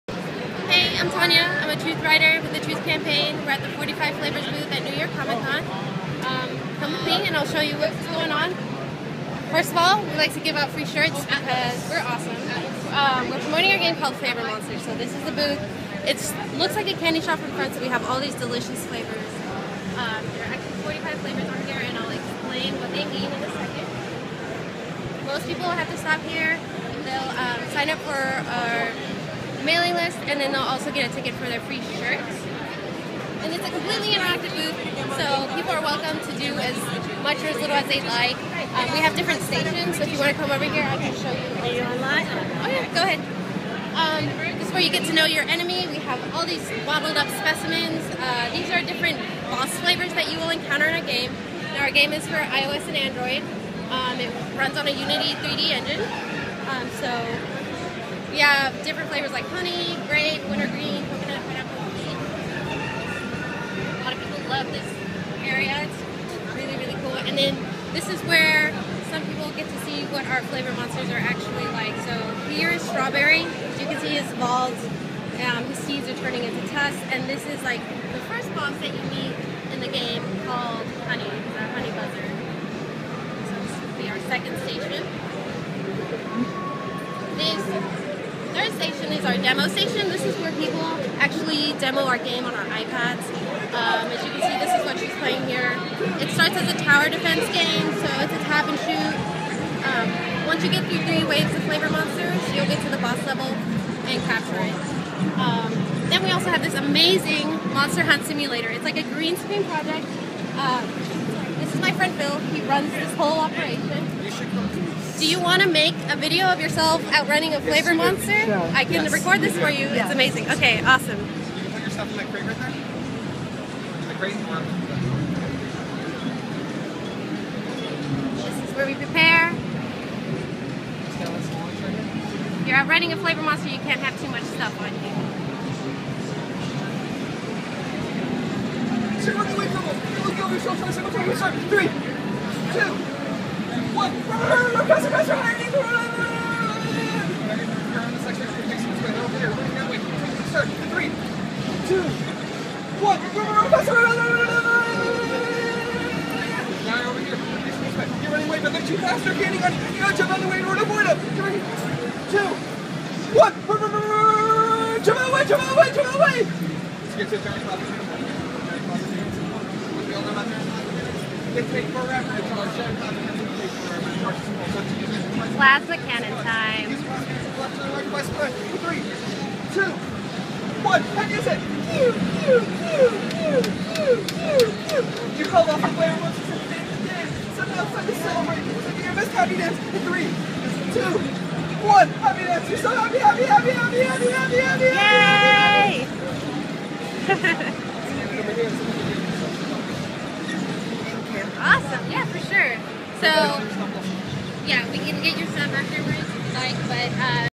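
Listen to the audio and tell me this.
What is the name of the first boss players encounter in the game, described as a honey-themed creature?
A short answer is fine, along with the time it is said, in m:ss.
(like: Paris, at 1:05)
Honey buzzard, at 1:21.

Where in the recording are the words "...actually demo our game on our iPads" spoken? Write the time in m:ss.
1:31.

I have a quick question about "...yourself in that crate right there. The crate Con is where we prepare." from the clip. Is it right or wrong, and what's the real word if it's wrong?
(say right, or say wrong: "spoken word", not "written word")
wrong: "This", not "Con".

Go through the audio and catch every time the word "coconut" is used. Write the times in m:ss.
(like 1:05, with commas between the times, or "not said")
1:01.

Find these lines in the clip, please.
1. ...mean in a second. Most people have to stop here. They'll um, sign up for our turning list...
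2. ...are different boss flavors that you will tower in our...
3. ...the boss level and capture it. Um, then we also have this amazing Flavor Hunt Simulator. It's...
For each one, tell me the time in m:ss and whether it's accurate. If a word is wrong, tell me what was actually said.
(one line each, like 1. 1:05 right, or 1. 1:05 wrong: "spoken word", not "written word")
1. 0:23 wrong: "mailing", not "turning"
2. 0:48 wrong: "encounter", not "tower"
3. 1:42 wrong: "Monster", not "Flavor".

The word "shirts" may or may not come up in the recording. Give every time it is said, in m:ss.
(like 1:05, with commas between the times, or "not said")
0:10, 0:31.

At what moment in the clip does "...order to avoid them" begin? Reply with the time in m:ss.
2:40.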